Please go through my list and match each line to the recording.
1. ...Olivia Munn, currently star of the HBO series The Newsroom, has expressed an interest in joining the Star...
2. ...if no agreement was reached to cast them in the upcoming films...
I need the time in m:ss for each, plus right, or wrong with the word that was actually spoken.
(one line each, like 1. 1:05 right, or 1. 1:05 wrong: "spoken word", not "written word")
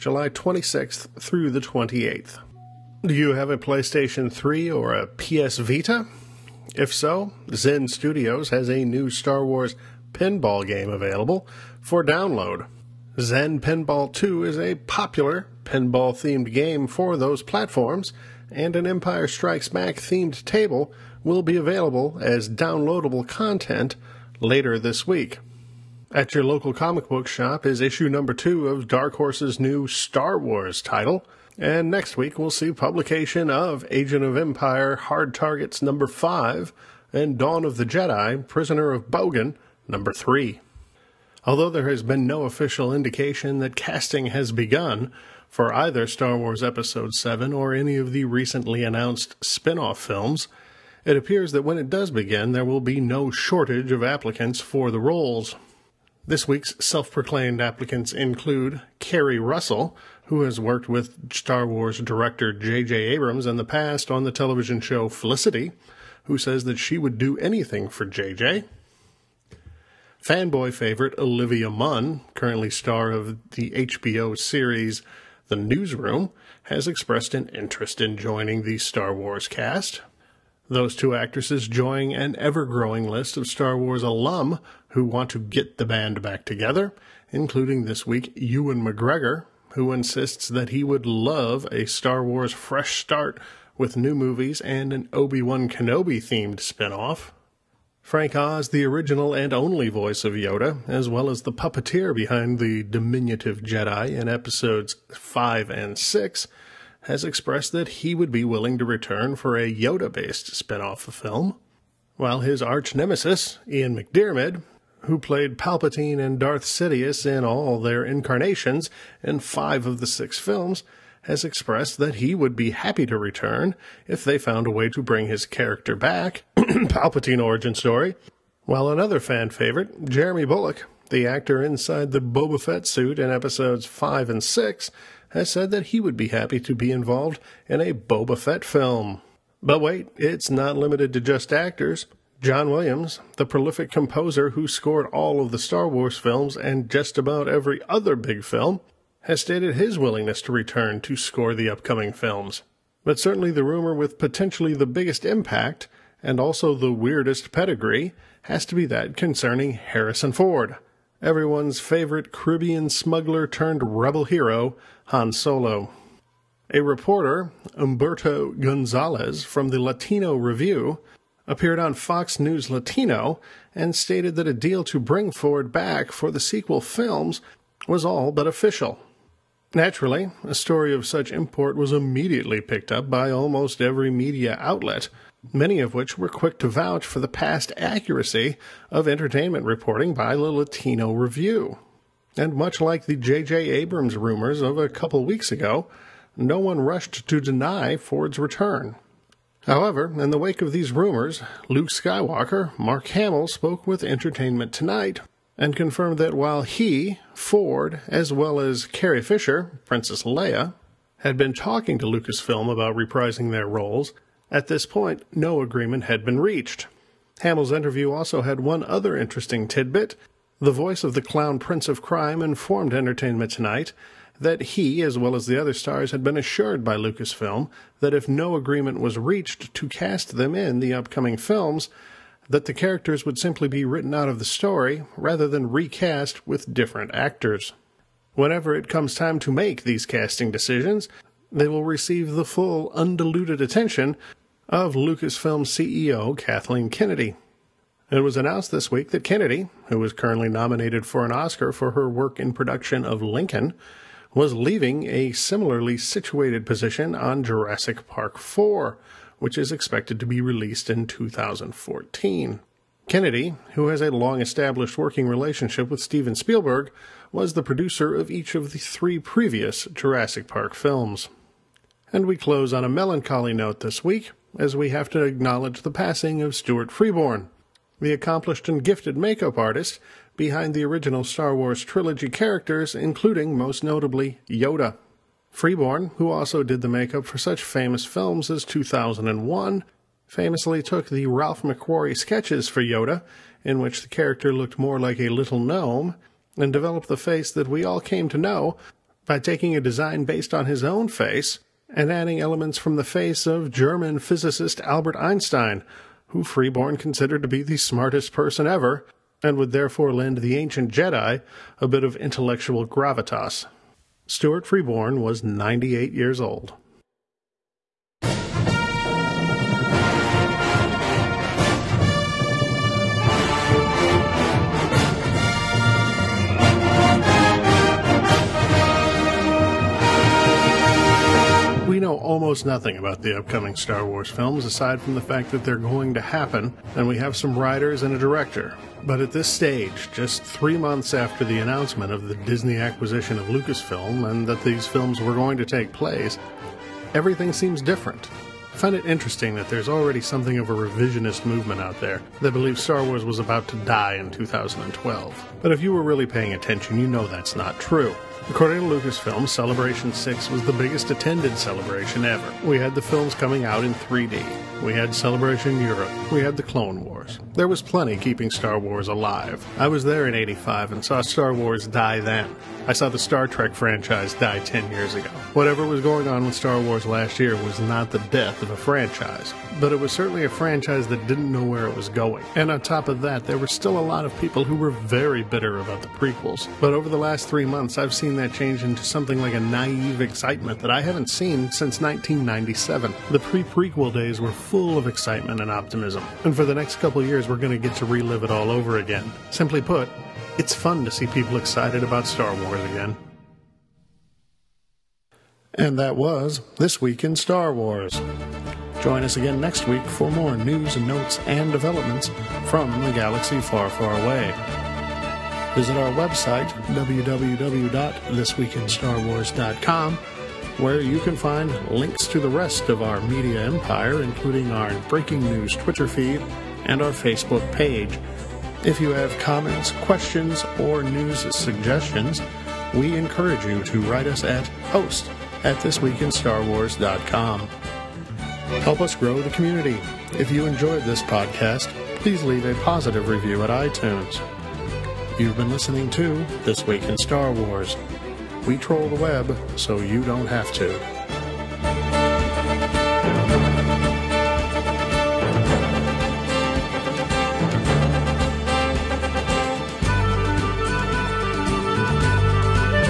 1. 1:11 right
2. 3:48 right.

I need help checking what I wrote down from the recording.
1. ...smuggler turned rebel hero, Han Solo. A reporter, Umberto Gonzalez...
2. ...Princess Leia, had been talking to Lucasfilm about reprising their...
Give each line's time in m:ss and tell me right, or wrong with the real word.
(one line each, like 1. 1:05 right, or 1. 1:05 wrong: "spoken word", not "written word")
1. 2:42 right
2. 3:29 right.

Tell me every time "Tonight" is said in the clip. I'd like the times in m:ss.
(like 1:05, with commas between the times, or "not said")
3:24, 3:43.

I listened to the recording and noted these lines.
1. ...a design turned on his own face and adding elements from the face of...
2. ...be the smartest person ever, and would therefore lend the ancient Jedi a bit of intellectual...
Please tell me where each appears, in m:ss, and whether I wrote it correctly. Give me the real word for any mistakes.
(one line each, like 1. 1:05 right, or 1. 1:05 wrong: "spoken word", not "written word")
1. 4:59 wrong: "based", not "turned"
2. 5:07 right.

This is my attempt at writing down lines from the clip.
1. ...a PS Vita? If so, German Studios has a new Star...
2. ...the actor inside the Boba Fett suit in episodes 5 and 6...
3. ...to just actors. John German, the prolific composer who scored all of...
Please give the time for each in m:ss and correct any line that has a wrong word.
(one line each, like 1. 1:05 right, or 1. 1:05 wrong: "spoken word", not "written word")
1. 0:04 wrong: "Zen", not "German"
2. 2:11 right
3. 2:21 wrong: "Williams", not "German".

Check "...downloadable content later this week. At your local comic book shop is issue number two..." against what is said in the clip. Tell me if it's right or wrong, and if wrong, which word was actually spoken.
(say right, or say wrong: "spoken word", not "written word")
right.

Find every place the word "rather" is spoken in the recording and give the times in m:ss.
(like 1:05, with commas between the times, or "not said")
3:55.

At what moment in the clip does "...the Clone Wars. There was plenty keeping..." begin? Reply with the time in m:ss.
6:06.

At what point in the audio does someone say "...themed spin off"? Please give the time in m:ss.
1:36.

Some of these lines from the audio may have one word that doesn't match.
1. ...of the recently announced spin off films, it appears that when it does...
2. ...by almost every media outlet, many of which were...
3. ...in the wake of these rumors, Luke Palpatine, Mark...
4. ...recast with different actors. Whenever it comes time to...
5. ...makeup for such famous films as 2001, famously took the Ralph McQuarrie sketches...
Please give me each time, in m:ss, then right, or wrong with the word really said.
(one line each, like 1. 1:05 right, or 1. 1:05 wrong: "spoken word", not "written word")
1. 0:47 right
2. 3:03 right
3. 3:20 wrong: "Skywalker", not "Palpatine"
4. 3:55 right
5. 4:46 right.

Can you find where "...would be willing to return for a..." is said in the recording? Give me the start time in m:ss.
1:48.